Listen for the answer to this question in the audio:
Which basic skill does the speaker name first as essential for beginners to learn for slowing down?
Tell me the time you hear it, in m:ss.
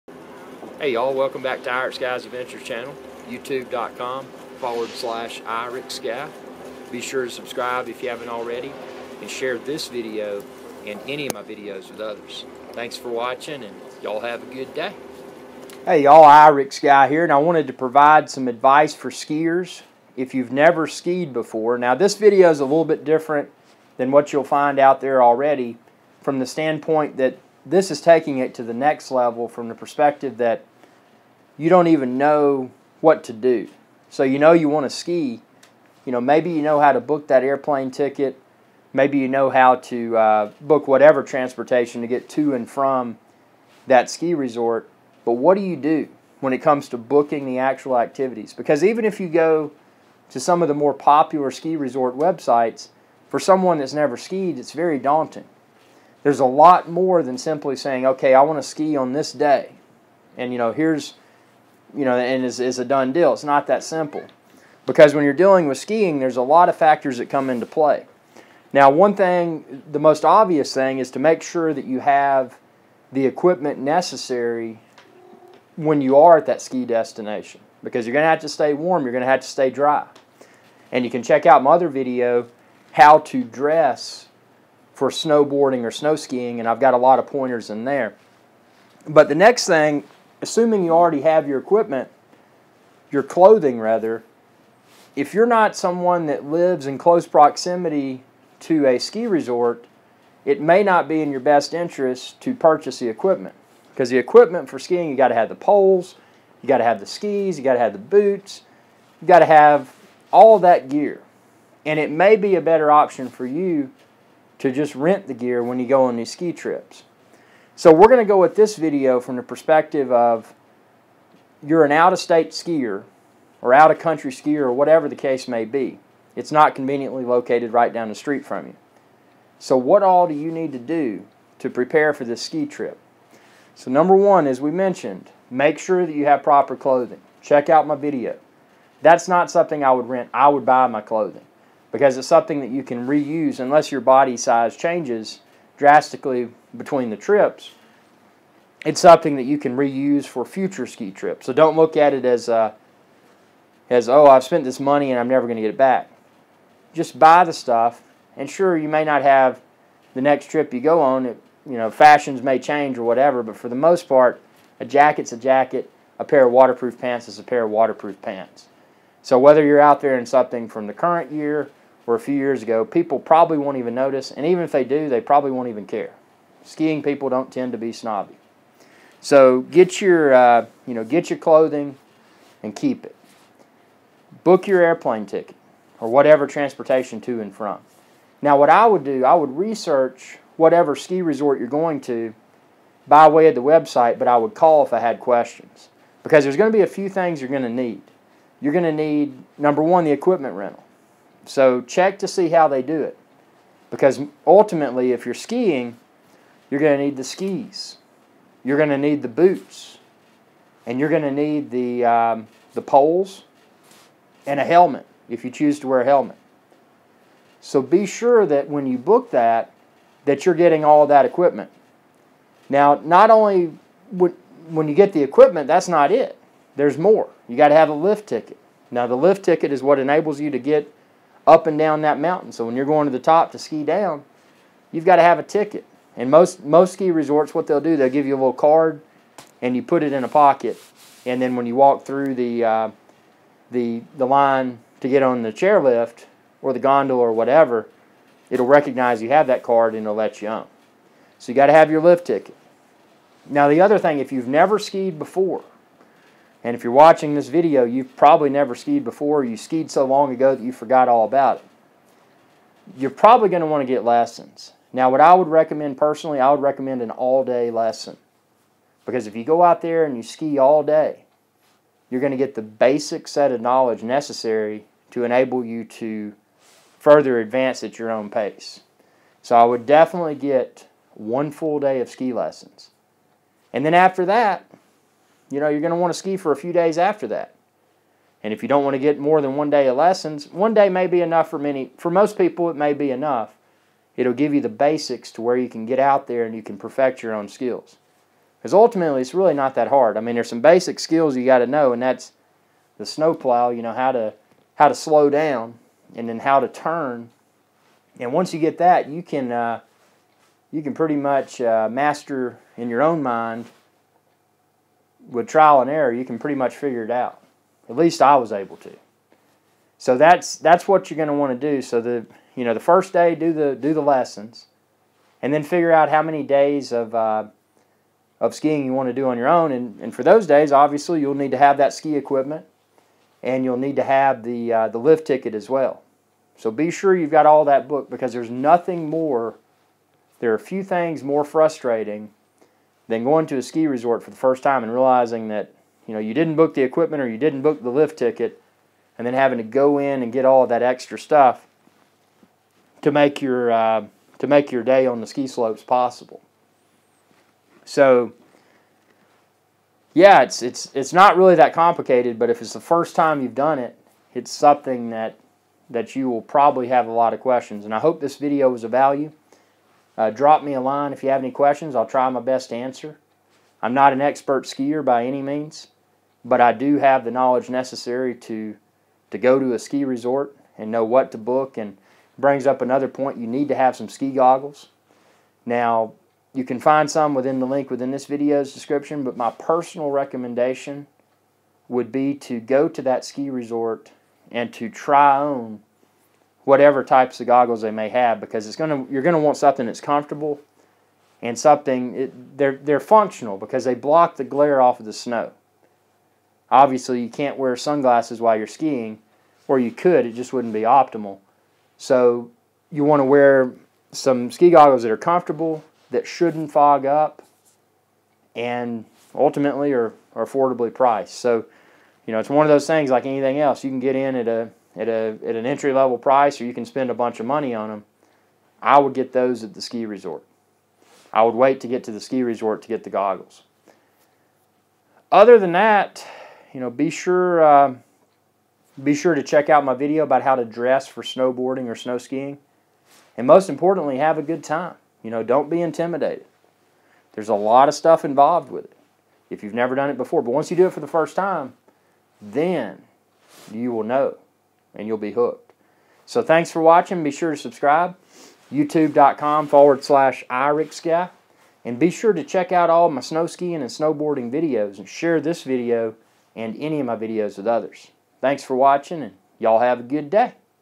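5:02.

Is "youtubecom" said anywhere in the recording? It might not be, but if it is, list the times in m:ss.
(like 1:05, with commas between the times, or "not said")
0:03, 7:38.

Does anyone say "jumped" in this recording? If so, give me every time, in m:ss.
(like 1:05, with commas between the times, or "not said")
not said.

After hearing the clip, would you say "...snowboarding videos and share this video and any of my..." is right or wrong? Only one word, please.
right.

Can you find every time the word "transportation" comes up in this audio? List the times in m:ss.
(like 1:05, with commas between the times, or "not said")
0:41, 3:06.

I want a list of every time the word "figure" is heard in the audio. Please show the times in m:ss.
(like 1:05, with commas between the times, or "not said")
5:16, 5:25.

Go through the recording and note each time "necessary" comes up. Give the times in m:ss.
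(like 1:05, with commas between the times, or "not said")
1:13, 4:34, 6:17.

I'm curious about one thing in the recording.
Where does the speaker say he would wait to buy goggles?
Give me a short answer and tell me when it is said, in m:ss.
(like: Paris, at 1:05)
at the ski resort, at 7:09.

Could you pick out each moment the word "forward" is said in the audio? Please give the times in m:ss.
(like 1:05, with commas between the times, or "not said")
0:04, 7:39.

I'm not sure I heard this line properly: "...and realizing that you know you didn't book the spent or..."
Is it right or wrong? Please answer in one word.
wrong.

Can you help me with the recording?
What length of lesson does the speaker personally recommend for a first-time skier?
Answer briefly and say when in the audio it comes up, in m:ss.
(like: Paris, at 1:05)
all-day lesson, at 4:27.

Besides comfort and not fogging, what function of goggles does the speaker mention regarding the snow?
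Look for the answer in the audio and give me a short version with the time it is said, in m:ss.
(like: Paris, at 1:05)
block the glare, at 6:43.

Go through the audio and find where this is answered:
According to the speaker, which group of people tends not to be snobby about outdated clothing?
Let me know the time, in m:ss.
2:56.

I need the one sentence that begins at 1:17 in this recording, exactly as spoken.
Because you're going to have to stay warm, you're going to have to stay dry.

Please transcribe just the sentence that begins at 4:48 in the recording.
And if you don't want to get more than one day of lessons, one day may be enough for many.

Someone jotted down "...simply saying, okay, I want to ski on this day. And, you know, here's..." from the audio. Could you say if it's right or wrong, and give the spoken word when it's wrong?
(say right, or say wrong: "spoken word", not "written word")
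right.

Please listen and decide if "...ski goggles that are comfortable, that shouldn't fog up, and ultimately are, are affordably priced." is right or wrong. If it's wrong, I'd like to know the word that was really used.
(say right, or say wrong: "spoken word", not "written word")
right.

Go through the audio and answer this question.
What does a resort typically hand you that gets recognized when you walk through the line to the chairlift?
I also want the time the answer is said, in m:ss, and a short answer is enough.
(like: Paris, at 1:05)
a little card, at 3:58.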